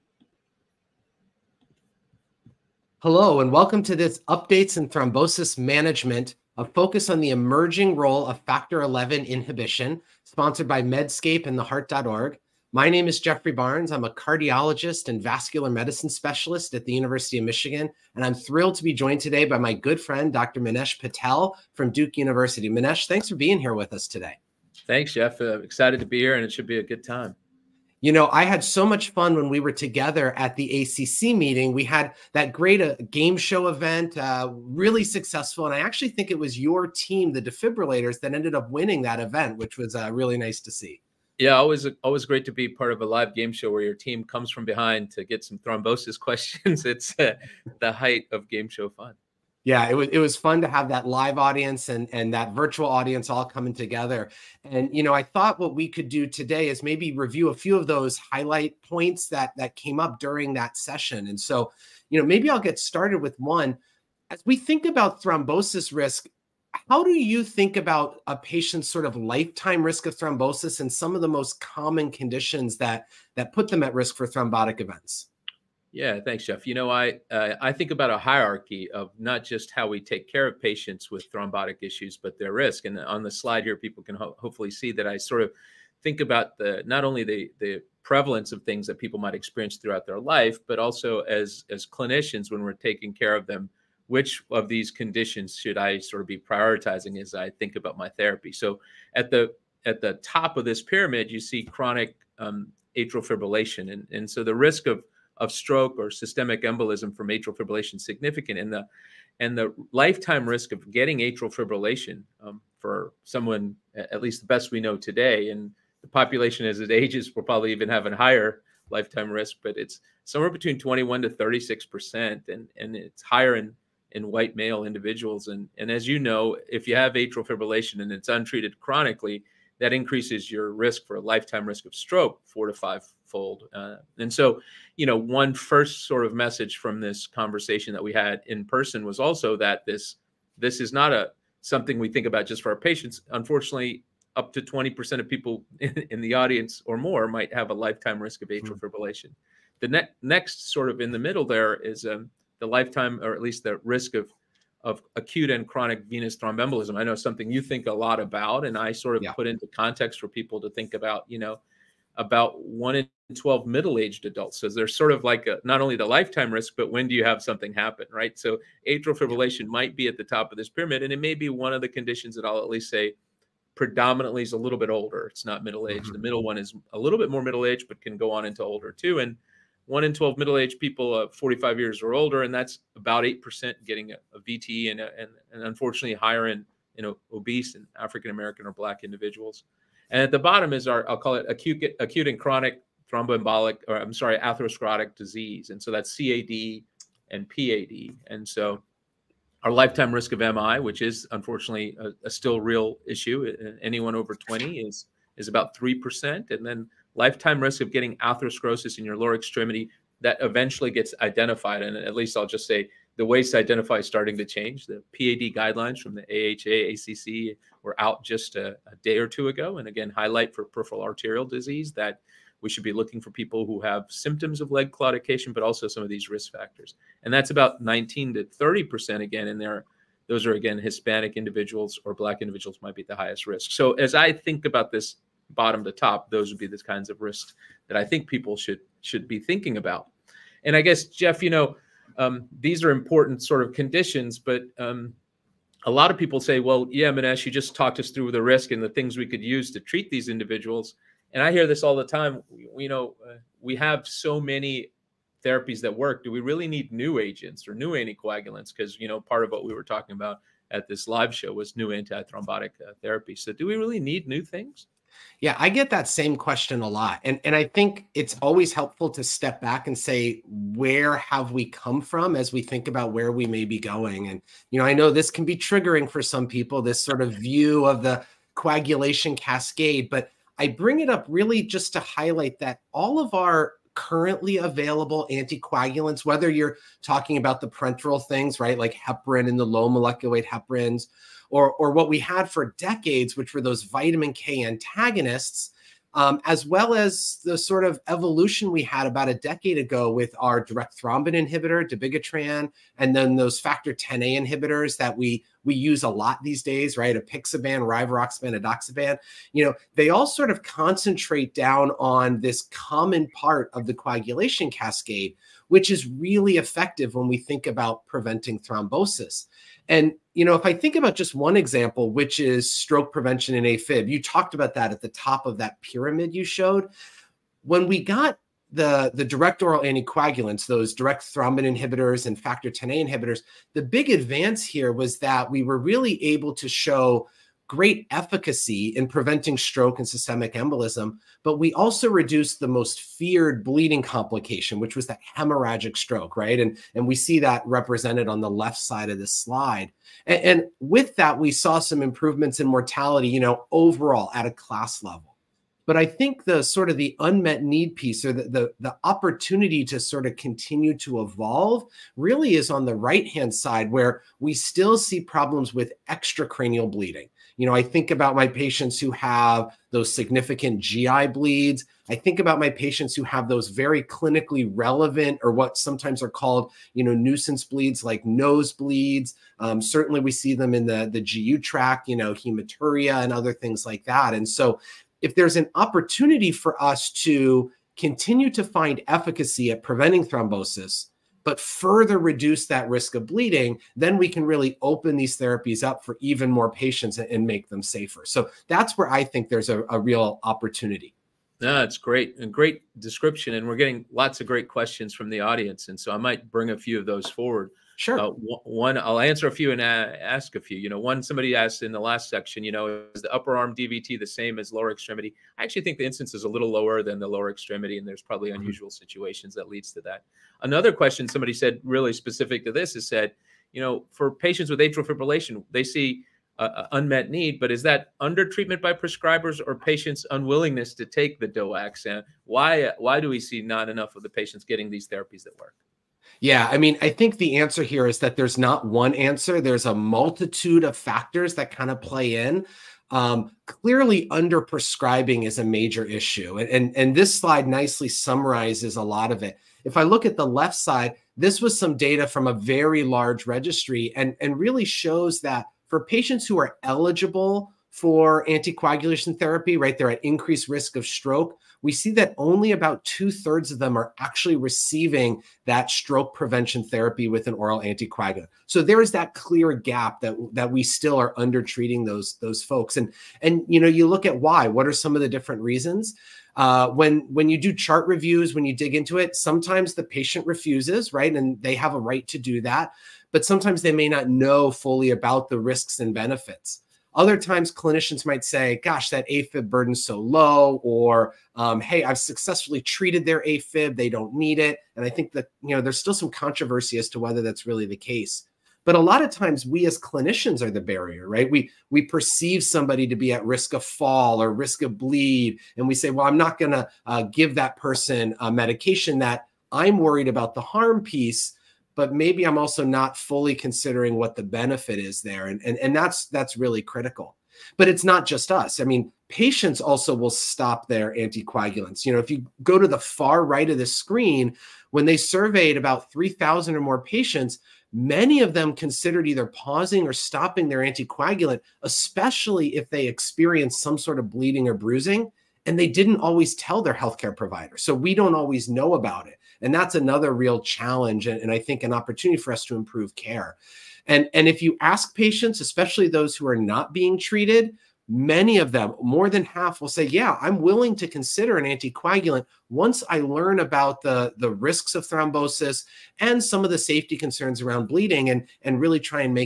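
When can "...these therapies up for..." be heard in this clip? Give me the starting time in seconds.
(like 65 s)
395 s.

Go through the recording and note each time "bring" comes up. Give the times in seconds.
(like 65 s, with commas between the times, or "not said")
280 s, 406 s.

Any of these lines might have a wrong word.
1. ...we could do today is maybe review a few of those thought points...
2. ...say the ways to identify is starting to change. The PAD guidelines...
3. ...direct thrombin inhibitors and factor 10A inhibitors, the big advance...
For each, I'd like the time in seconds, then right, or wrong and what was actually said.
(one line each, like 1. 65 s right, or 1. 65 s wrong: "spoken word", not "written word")
1. 55 s wrong: "highlight", not "thought"
2. 212 s right
3. 330 s right.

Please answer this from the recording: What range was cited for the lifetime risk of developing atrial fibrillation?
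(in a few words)
21 to 36 percent.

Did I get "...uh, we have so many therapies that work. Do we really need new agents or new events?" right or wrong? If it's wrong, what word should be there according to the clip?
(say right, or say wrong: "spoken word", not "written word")
wrong: "anticoagulants", not "events".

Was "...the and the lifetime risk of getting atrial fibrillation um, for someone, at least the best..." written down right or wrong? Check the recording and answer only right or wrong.
right.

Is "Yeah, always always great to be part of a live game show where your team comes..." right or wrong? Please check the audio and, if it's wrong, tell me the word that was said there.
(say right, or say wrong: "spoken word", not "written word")
right.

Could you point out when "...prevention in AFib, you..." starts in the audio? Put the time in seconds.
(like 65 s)
323 s.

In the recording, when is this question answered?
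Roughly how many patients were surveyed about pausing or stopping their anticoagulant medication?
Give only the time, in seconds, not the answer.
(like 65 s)
526 s.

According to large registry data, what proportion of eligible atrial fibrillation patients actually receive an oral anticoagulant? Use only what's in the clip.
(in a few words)
about two thirds.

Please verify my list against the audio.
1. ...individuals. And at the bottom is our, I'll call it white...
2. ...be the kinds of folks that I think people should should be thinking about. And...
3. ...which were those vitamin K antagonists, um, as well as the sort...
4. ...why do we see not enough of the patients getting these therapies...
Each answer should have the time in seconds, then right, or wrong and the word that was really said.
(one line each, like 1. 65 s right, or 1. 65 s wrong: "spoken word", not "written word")
1. 189 s wrong: "acute", not "white"
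2. 236 s wrong: "risks", not "folks"
3. 293 s right
4. 432 s right.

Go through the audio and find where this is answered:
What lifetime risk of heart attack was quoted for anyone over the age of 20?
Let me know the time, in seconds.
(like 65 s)
205 s.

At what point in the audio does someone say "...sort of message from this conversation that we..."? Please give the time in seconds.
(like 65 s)
136 s.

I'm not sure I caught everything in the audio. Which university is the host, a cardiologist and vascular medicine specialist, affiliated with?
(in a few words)
University of Michigan.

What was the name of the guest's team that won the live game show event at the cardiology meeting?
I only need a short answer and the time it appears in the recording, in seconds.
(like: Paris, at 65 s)
the defibrillators, at 37 s.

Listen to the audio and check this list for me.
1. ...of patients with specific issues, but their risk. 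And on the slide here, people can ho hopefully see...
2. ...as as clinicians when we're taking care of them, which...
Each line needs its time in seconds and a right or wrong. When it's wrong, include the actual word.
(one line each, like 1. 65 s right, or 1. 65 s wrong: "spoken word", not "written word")
1. 80 s wrong: "thrombotic", not "specific"
2. 91 s right.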